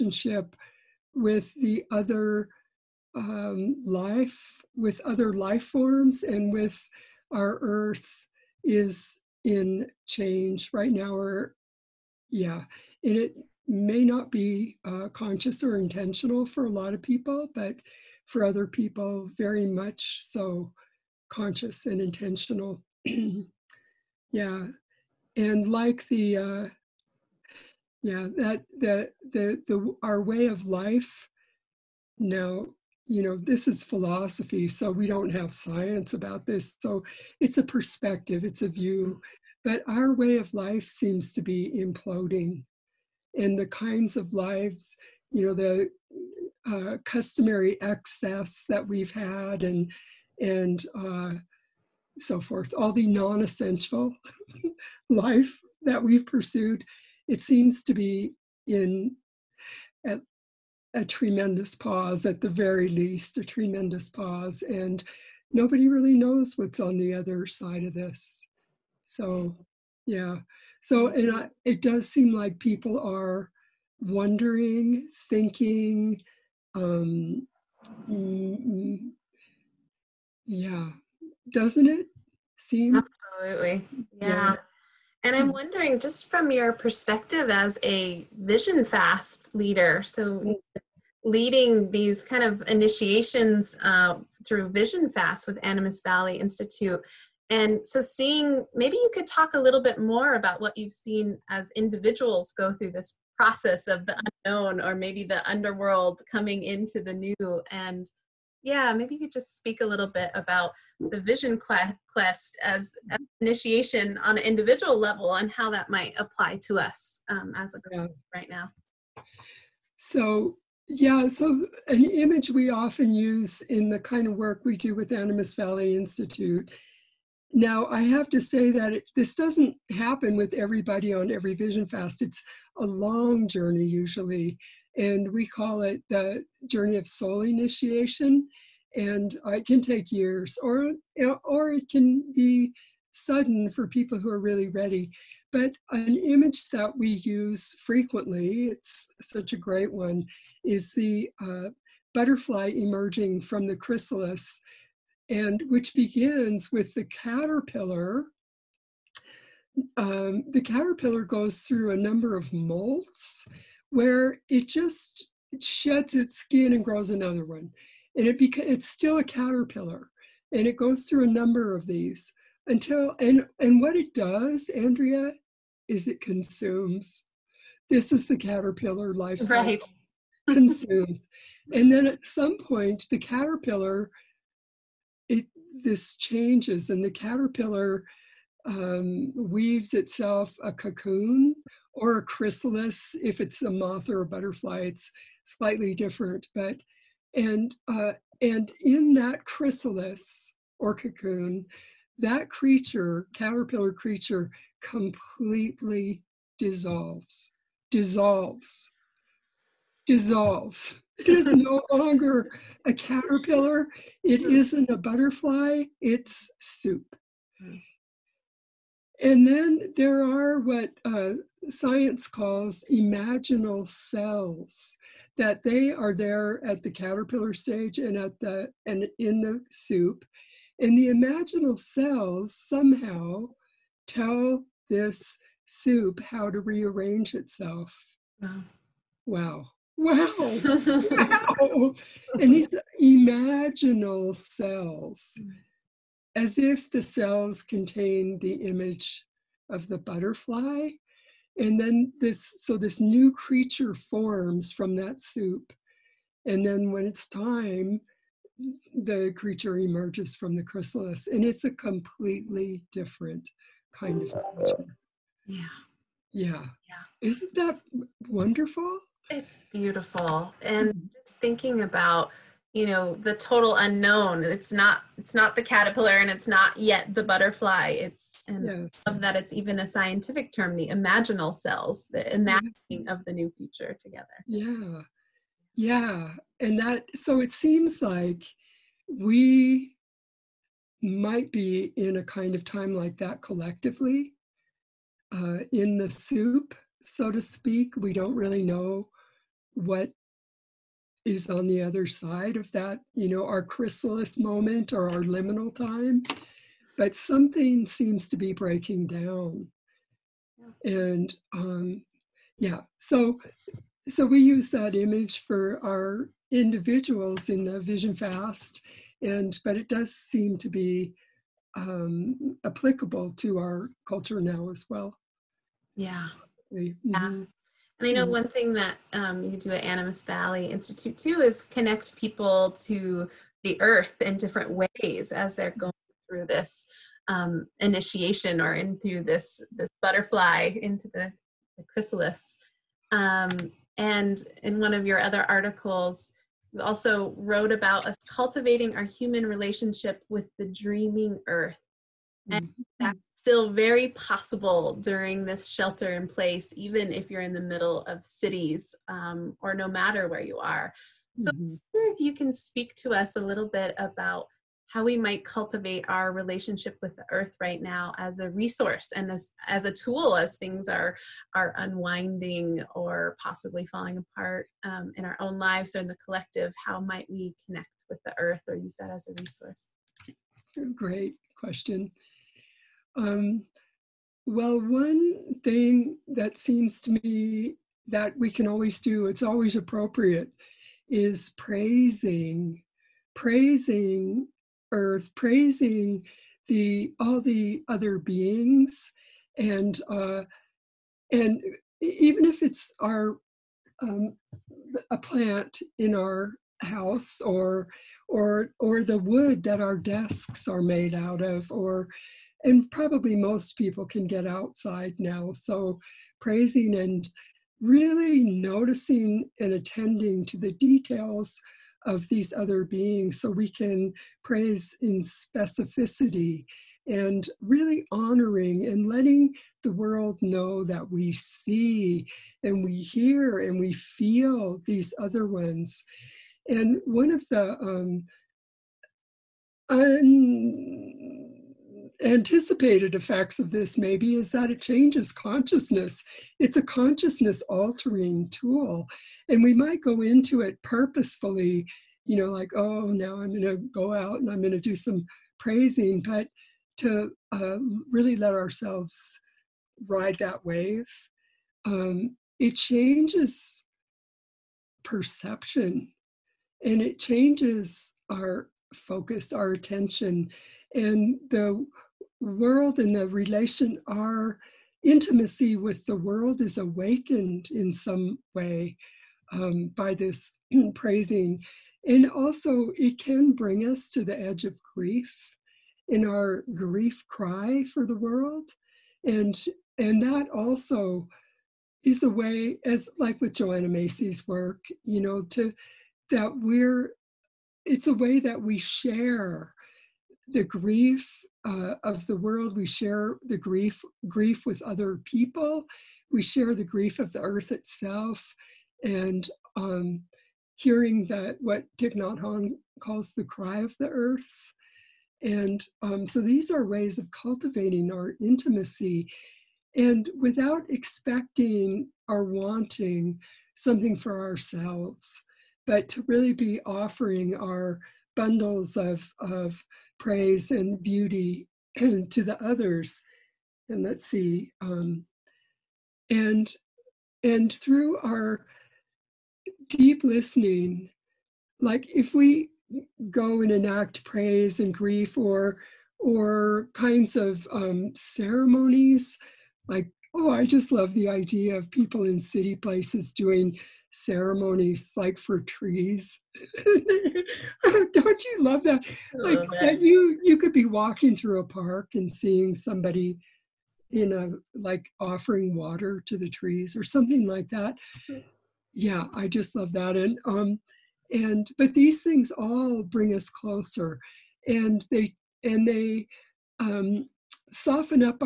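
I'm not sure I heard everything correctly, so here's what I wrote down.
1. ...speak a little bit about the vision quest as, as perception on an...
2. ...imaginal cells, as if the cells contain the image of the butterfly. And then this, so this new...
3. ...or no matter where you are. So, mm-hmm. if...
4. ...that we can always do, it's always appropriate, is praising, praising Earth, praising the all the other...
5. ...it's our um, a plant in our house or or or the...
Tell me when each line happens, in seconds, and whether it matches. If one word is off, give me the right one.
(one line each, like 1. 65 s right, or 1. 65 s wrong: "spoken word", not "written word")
1. 109 s wrong: "initiation", not "perception"
2. 243 s right
3. 359 s right
4. 388 s right
5. 402 s right.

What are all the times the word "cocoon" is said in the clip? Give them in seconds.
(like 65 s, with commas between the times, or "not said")
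190 s, 200 s.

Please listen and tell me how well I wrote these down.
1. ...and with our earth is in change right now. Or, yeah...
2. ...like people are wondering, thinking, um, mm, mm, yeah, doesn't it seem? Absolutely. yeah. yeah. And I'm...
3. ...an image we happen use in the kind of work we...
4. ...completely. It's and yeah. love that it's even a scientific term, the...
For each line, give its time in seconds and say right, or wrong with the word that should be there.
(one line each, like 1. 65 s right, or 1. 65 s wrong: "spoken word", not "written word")
1. 6 s right
2. 72 s right
3. 121 s wrong: "often", not "happen"
4. 277 s wrong: "butterfly", not "completely".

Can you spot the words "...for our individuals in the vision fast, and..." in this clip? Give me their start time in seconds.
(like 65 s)
315 s.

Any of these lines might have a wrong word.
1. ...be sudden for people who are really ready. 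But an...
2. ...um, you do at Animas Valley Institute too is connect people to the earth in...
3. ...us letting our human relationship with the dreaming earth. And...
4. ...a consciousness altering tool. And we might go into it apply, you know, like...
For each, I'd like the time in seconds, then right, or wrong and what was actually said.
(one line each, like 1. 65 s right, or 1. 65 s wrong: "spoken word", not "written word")
1. 142 s right
2. 329 s right
3. 348 s wrong: "cultivating", not "letting"
4. 446 s wrong: "purposefully", not "apply".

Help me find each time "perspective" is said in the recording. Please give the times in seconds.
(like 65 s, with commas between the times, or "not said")
37 s, 86 s.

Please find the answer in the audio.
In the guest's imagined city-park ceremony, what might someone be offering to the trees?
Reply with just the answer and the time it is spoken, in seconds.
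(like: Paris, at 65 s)
water, at 565 s.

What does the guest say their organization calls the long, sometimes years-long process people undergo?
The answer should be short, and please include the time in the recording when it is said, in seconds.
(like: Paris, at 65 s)
soul initiation, at 137 s.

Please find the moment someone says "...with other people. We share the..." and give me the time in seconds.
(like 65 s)
504 s.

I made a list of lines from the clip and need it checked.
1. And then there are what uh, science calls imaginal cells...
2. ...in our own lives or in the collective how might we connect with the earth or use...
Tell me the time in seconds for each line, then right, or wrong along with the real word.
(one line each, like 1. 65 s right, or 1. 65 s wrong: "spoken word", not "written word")
1. 219 s right
2. 375 s right.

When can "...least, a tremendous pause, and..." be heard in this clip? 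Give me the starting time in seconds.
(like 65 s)
62 s.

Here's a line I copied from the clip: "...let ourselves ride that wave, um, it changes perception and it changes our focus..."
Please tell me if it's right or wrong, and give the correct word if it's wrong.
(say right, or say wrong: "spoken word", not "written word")
right.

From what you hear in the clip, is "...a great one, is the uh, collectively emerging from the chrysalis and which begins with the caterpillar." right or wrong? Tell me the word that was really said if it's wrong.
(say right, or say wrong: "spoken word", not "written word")
wrong: "butterfly", not "collectively".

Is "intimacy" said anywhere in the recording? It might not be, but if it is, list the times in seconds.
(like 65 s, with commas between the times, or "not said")
475 s, 518 s.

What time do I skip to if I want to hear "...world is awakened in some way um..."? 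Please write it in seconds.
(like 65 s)
476 s.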